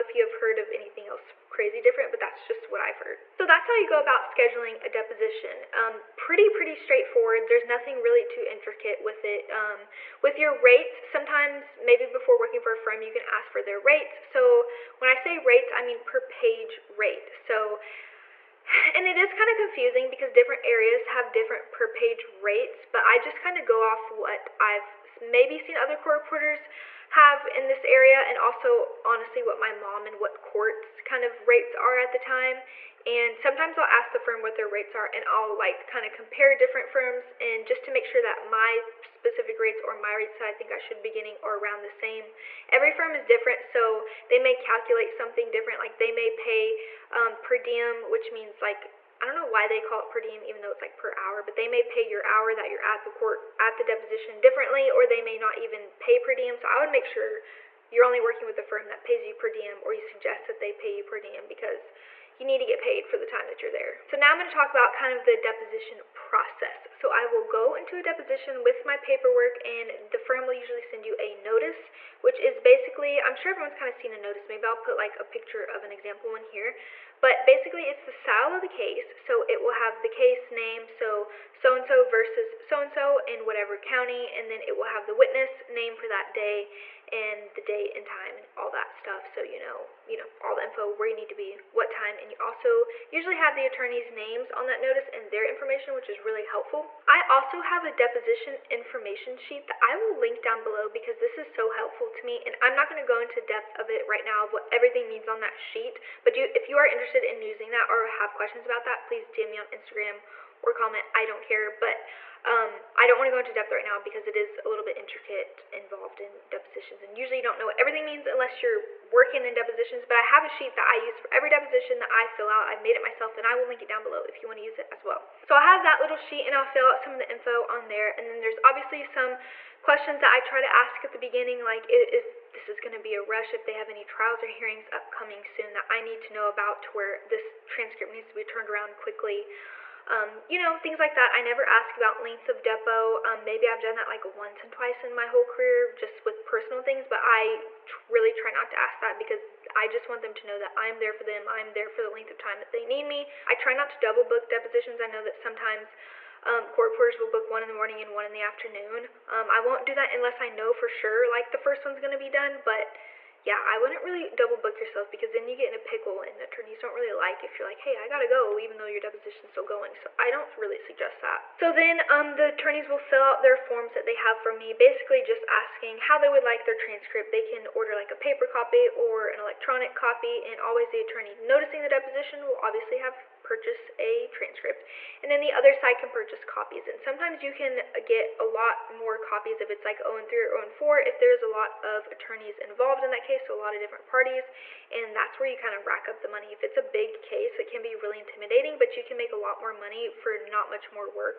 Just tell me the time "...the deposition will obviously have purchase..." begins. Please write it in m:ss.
3:01.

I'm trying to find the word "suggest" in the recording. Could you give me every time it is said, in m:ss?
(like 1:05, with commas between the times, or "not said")
0:59, 2:50.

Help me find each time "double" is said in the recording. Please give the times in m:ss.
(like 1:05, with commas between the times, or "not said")
2:33, 2:44.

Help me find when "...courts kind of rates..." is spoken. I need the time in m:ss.
0:30.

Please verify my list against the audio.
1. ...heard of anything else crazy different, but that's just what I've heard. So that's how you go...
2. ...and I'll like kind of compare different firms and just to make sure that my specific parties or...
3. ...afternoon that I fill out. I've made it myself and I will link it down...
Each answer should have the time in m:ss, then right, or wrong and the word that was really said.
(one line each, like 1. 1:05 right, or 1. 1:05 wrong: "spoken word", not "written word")
1. 0:00 right
2. 0:35 wrong: "rates", not "parties"
3. 2:01 wrong: "deposition", not "afternoon".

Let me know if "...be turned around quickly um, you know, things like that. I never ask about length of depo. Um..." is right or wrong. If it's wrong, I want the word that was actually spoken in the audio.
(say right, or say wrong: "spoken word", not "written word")
right.